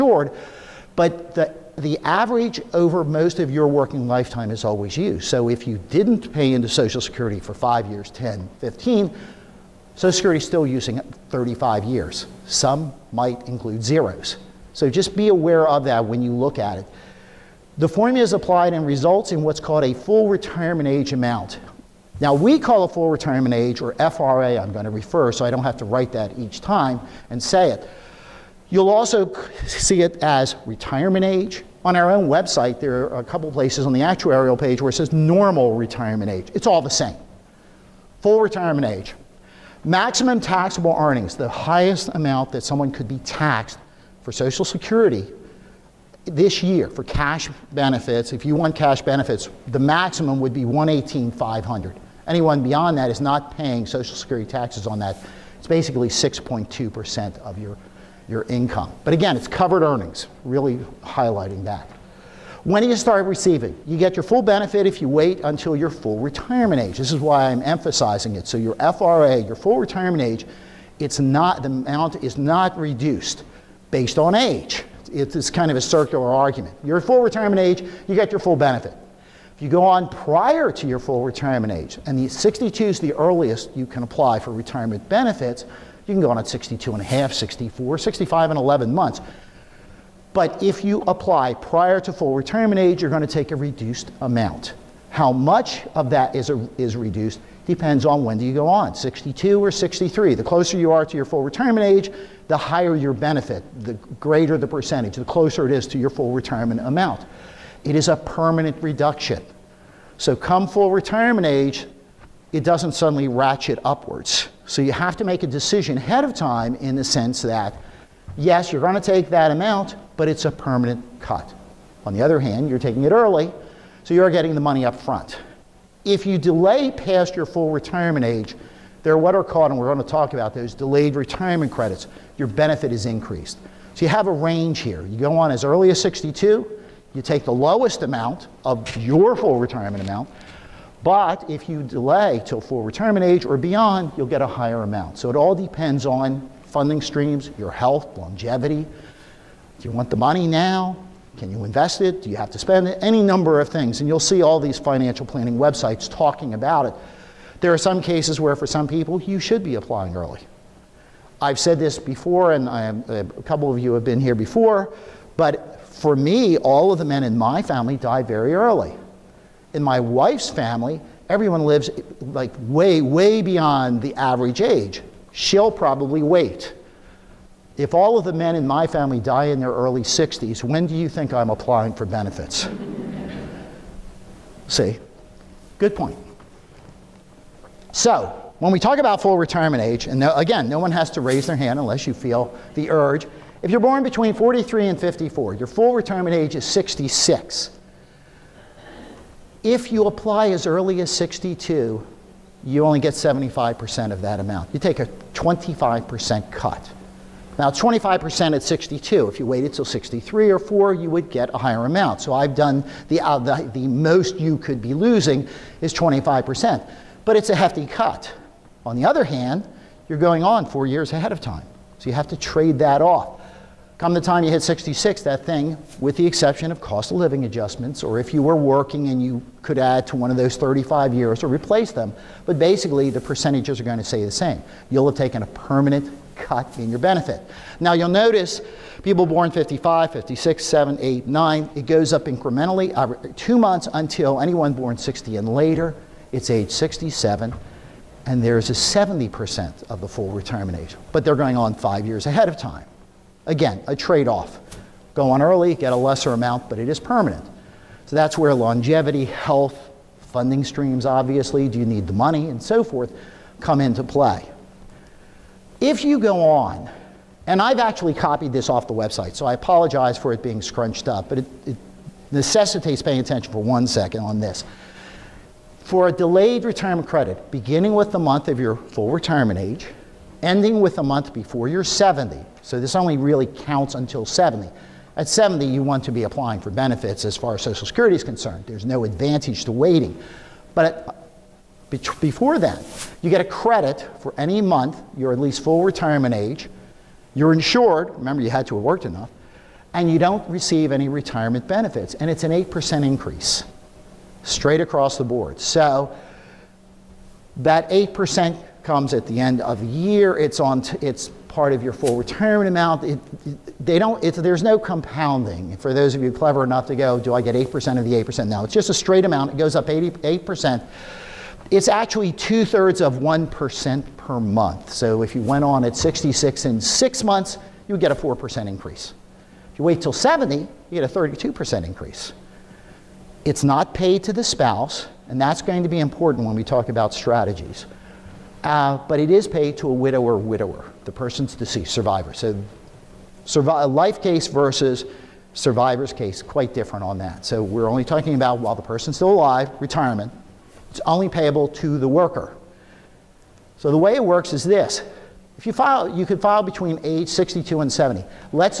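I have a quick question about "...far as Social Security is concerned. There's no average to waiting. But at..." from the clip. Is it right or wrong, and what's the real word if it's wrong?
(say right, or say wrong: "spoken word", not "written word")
wrong: "advantage", not "average".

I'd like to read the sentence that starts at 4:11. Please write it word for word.
But they're going on five years ahead of time.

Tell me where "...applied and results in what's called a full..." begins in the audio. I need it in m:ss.
0:18.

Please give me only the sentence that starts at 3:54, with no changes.
You'll have taken a permanent cut in your benefit.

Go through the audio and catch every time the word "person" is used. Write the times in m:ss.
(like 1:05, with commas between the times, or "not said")
5:41, 5:48.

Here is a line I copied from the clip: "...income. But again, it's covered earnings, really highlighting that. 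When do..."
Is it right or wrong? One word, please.
right.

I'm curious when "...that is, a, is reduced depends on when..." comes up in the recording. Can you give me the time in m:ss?
1:36.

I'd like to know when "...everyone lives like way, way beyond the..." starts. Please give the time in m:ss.
2:51.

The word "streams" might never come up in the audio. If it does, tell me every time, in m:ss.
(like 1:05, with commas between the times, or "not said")
2:27, 4:20.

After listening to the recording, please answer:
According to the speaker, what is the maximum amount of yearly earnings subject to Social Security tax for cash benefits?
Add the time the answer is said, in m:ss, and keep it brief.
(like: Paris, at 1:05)
118,500, at 0:50.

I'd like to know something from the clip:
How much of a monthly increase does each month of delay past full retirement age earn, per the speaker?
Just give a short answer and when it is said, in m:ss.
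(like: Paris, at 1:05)
two thirds of one percent, at 5:22.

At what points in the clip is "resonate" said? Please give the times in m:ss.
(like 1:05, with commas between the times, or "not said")
not said.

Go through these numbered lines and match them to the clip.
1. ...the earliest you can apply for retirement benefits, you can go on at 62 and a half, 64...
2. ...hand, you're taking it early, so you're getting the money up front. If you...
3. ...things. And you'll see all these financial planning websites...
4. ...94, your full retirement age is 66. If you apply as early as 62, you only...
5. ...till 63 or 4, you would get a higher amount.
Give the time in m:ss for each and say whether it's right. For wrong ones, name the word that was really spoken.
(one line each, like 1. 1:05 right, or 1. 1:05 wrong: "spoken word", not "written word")
1. 1:23 right
2. 2:02 right
3. 2:33 right
4. 3:15 wrong: "54", not "94"
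5. 3:29 right.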